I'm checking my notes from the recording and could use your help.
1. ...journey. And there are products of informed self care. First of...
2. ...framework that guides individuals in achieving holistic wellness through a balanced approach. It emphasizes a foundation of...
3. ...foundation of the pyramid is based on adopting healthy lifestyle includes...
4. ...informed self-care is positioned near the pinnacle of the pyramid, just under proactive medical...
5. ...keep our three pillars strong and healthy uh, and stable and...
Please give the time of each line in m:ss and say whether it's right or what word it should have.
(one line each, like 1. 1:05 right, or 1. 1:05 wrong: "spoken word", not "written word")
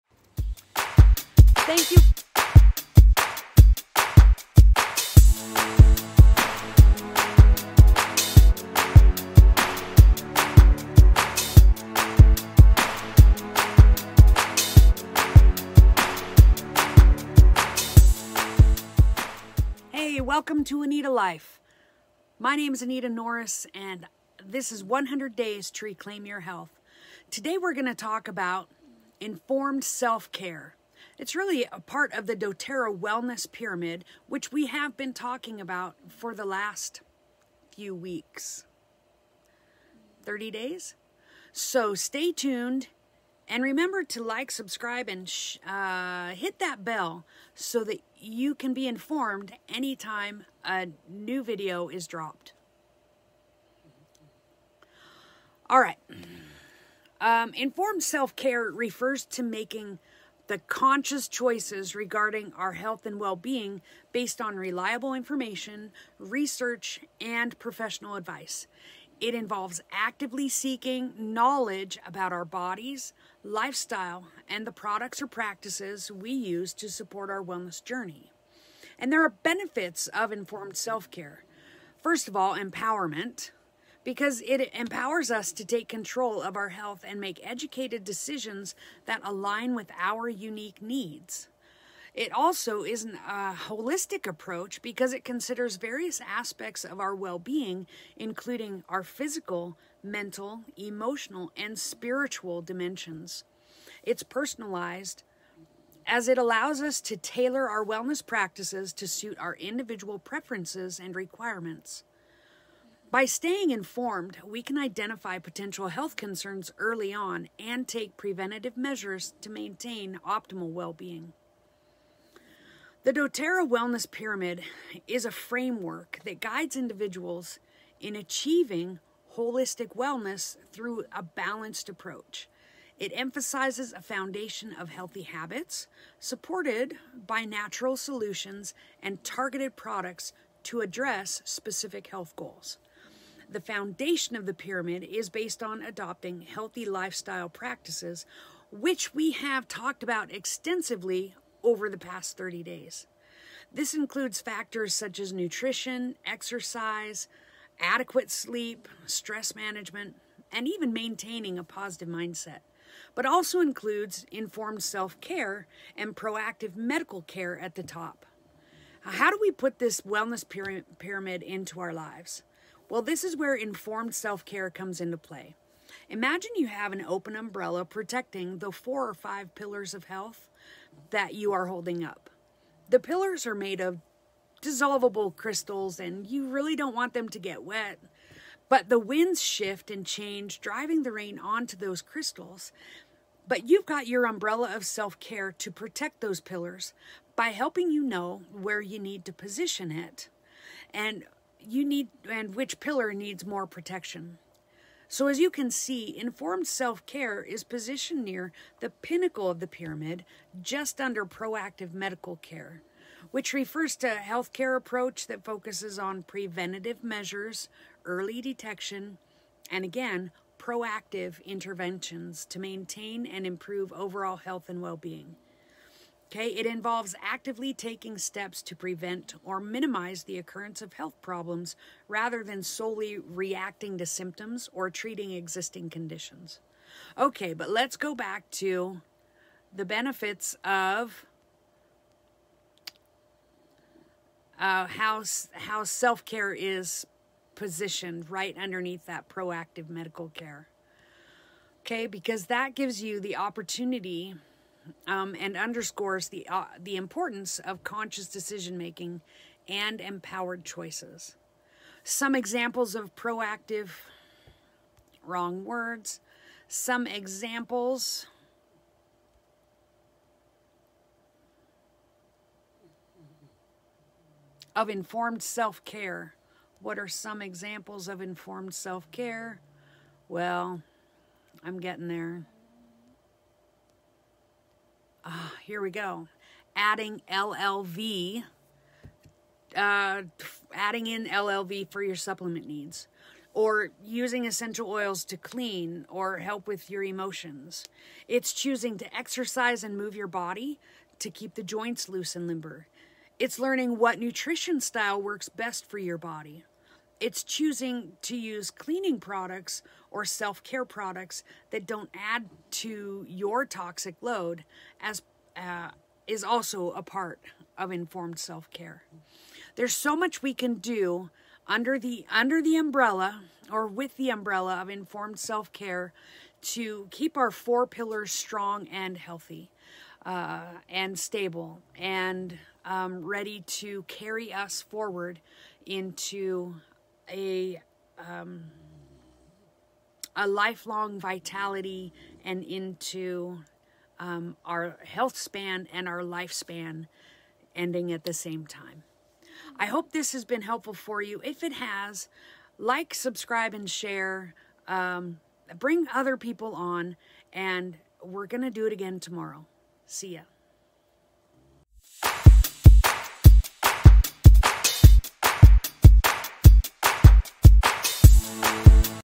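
1. 1:17 wrong: "benefits", not "products"
2. 2:05 right
3. 2:23 wrong: "practices", not "includes"
4. 3:26 right
5. 5:27 wrong: "four", not "three".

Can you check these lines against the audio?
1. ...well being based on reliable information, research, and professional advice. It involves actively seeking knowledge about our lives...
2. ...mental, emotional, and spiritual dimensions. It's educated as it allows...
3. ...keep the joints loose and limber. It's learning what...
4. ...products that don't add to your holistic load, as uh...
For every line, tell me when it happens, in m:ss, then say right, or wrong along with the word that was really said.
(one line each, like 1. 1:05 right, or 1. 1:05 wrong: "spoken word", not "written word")
1. 1:03 wrong: "bodies", not "lives"
2. 1:40 wrong: "personalized", not "educated"
3. 5:01 right
4. 5:10 wrong: "toxic", not "holistic".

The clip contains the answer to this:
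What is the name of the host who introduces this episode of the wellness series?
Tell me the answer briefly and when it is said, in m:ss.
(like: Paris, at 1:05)
Anita Norris, at 0:22.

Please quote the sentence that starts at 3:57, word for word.
Okay, but let's go back to the benefits of uh, how, how self care is positioned right underneath that proactive medical care.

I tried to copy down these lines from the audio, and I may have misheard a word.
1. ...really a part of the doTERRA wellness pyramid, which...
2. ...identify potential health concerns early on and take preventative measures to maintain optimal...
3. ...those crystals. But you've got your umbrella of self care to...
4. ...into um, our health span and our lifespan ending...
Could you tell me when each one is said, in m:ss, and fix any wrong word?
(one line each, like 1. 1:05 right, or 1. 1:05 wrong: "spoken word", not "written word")
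1. 0:31 right
2. 1:54 right
3. 3:11 right
4. 5:42 right.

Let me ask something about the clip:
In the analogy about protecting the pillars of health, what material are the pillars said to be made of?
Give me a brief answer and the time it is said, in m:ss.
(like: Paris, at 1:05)
dissolvable crystals, at 3:04.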